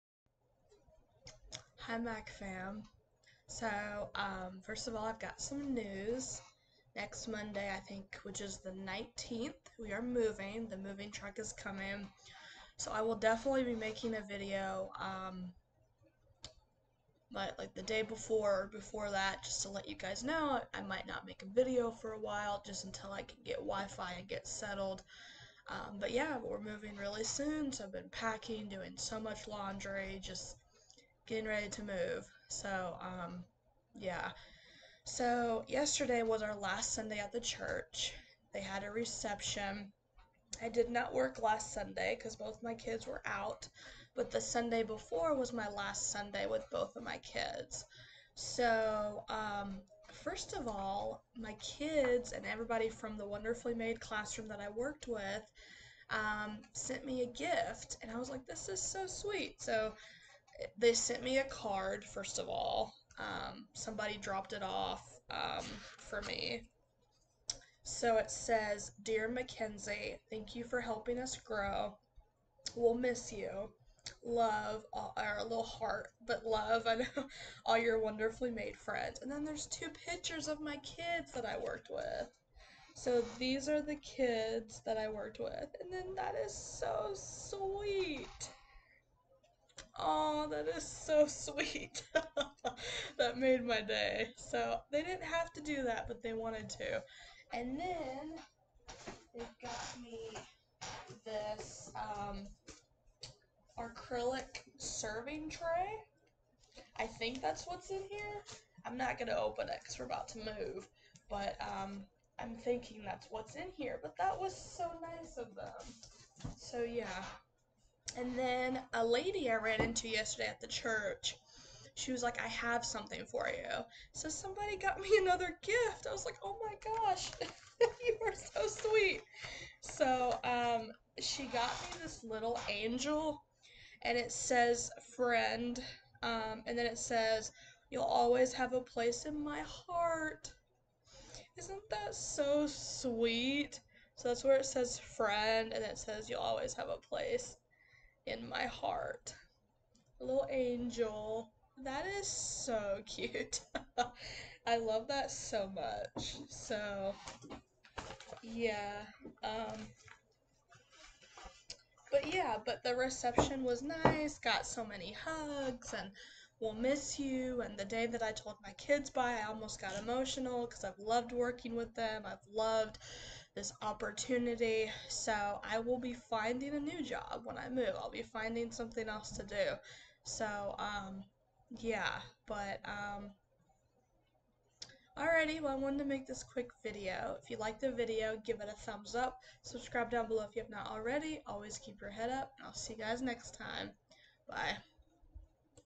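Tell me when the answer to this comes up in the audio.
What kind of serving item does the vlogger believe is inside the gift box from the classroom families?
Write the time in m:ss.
1:43.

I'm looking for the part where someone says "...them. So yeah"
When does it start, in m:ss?
1:55.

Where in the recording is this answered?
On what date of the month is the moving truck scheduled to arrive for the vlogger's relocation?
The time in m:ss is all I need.
0:08.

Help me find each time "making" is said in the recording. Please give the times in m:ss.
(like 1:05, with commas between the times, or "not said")
0:13.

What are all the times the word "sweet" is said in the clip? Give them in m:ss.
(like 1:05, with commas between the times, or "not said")
0:59, 1:27, 1:31, 2:08, 2:22.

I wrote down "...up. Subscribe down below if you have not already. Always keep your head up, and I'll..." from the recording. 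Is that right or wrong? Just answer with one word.
right.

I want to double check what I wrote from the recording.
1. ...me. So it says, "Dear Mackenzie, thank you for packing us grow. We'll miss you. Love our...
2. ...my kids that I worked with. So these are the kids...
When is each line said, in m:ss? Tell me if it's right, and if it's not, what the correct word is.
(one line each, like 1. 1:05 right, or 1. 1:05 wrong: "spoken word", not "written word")
1. 1:06 wrong: "helping", not "packing"
2. 1:20 right.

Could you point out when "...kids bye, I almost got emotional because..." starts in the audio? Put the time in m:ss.
2:48.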